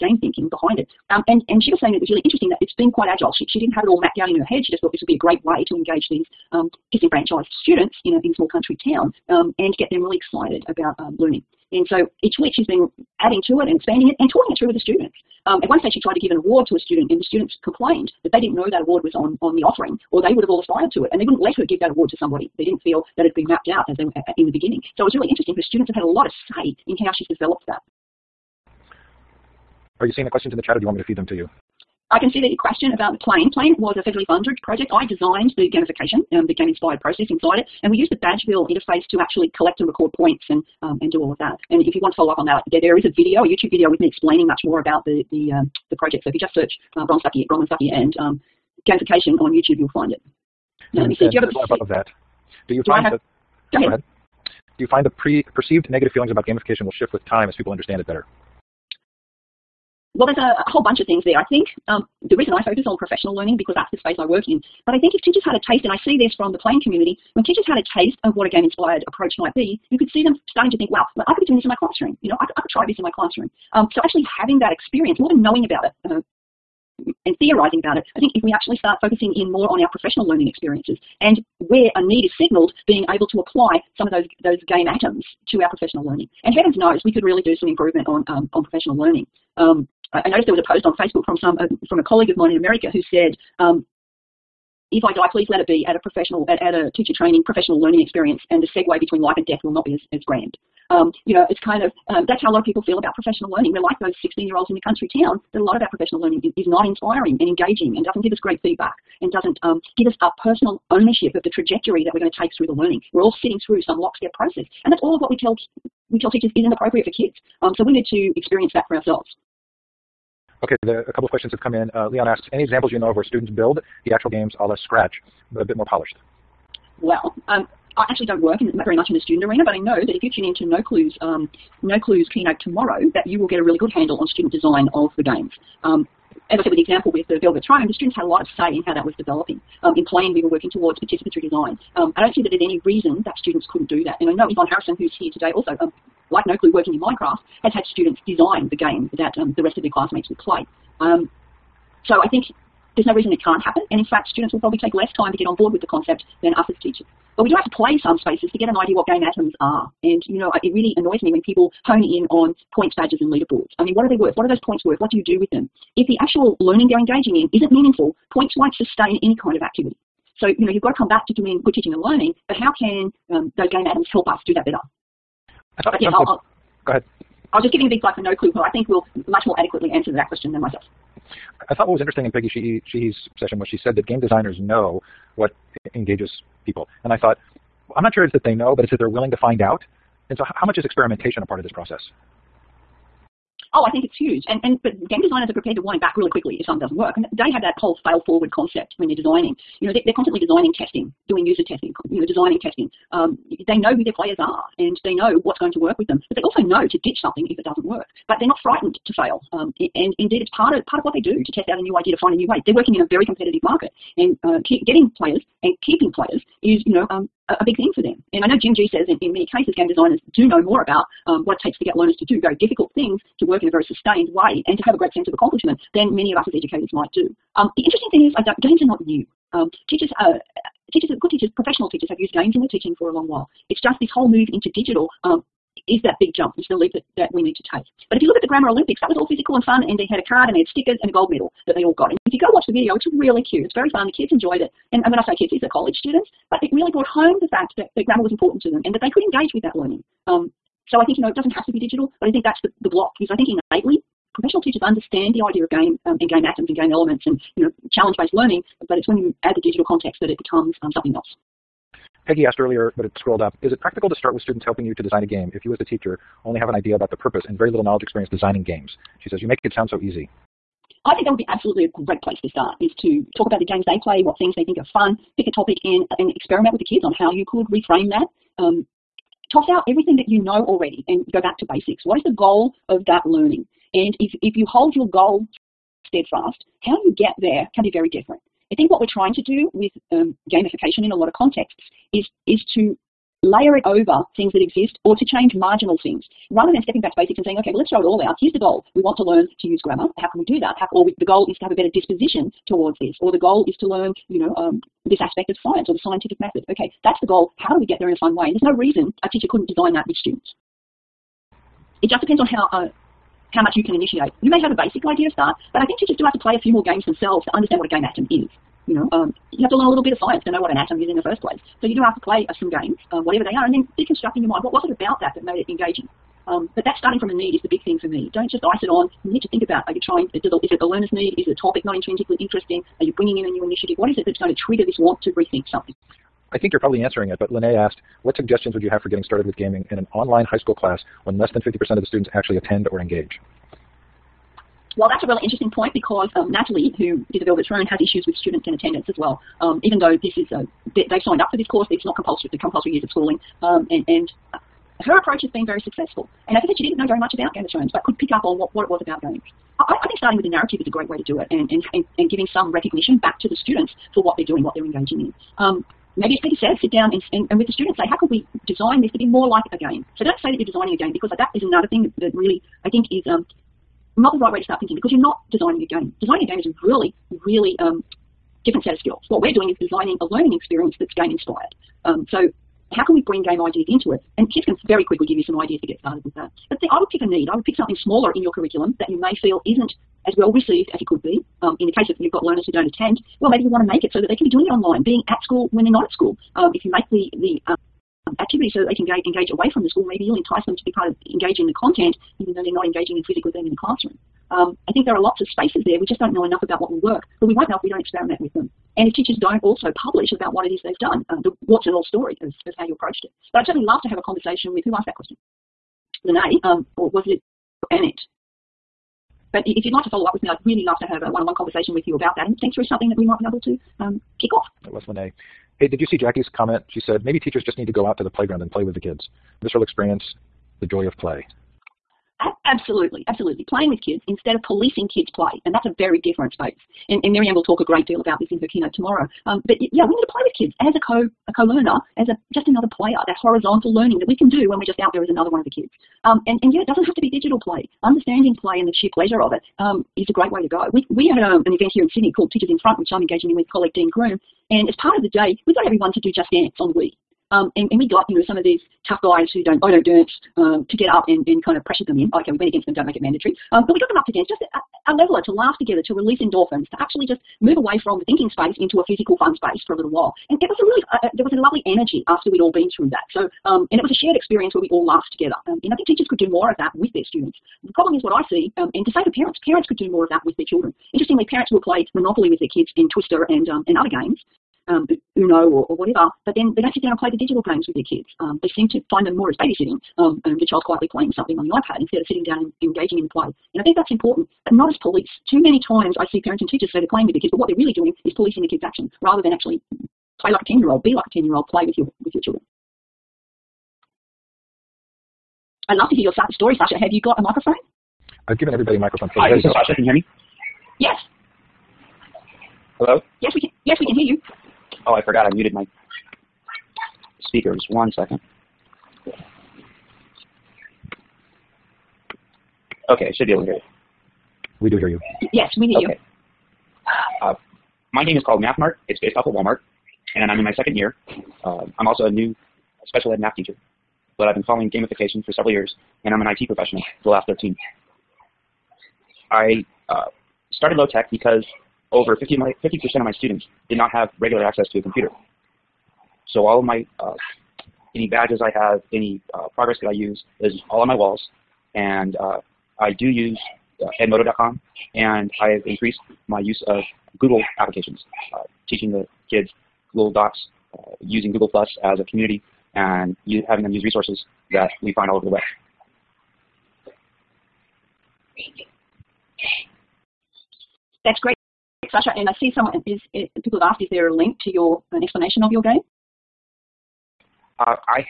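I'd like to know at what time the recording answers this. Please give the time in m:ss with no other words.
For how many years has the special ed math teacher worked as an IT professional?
8:57.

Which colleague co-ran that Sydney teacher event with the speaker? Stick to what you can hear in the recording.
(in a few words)
Dean Groom.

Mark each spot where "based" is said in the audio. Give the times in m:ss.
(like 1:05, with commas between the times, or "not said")
4:17, 8:49.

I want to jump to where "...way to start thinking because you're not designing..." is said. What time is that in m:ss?
6:14.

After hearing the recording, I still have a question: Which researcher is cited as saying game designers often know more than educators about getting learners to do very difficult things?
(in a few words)
Jim Gee.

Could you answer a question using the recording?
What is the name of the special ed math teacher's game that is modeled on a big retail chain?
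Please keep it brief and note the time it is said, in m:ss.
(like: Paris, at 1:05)
MathMart, at 8:48.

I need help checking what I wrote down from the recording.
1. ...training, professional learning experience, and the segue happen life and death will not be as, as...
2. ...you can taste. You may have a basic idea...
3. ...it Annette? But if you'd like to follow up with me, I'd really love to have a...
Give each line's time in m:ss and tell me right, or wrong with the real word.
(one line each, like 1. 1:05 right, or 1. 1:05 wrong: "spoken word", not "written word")
1. 1:37 wrong: "between", not "happen"
2. 5:13 wrong: "initiate", not "taste"
3. 6:57 right.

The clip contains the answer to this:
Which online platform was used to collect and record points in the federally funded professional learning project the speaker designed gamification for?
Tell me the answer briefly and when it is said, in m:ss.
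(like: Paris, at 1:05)
Badgeville, at 0:38.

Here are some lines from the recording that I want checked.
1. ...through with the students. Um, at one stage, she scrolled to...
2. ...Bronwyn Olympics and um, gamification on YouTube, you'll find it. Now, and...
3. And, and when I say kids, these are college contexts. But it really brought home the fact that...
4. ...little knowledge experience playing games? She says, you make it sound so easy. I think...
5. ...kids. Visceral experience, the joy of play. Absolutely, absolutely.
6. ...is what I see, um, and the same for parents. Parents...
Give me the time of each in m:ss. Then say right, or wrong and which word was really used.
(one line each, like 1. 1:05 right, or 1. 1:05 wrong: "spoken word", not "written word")
1. 0:14 wrong: "tried", not "scrolled"
2. 0:47 wrong: "Stuckey", not "Olympics"
3. 4:04 wrong: "students", not "contexts"
4. 4:27 wrong: "designing", not "playing"
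5. 7:08 right
6. 7:58 right.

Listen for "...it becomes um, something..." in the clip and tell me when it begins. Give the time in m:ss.
4:20.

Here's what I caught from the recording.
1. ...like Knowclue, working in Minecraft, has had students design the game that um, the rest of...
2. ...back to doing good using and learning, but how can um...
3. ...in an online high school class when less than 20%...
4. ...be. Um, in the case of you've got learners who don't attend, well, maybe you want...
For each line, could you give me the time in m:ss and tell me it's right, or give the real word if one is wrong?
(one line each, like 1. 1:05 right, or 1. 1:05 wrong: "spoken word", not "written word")
1. 2:26 right
2. 2:51 wrong: "teaching", not "using"
3. 5:39 wrong: "50", not "20"
4. 6:31 right.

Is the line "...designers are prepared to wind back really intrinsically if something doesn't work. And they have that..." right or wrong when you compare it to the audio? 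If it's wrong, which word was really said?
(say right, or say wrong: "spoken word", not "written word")
wrong: "quickly", not "intrinsically".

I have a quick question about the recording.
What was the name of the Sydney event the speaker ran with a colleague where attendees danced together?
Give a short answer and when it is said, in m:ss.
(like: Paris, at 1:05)
Teachers in Front, at 7:32.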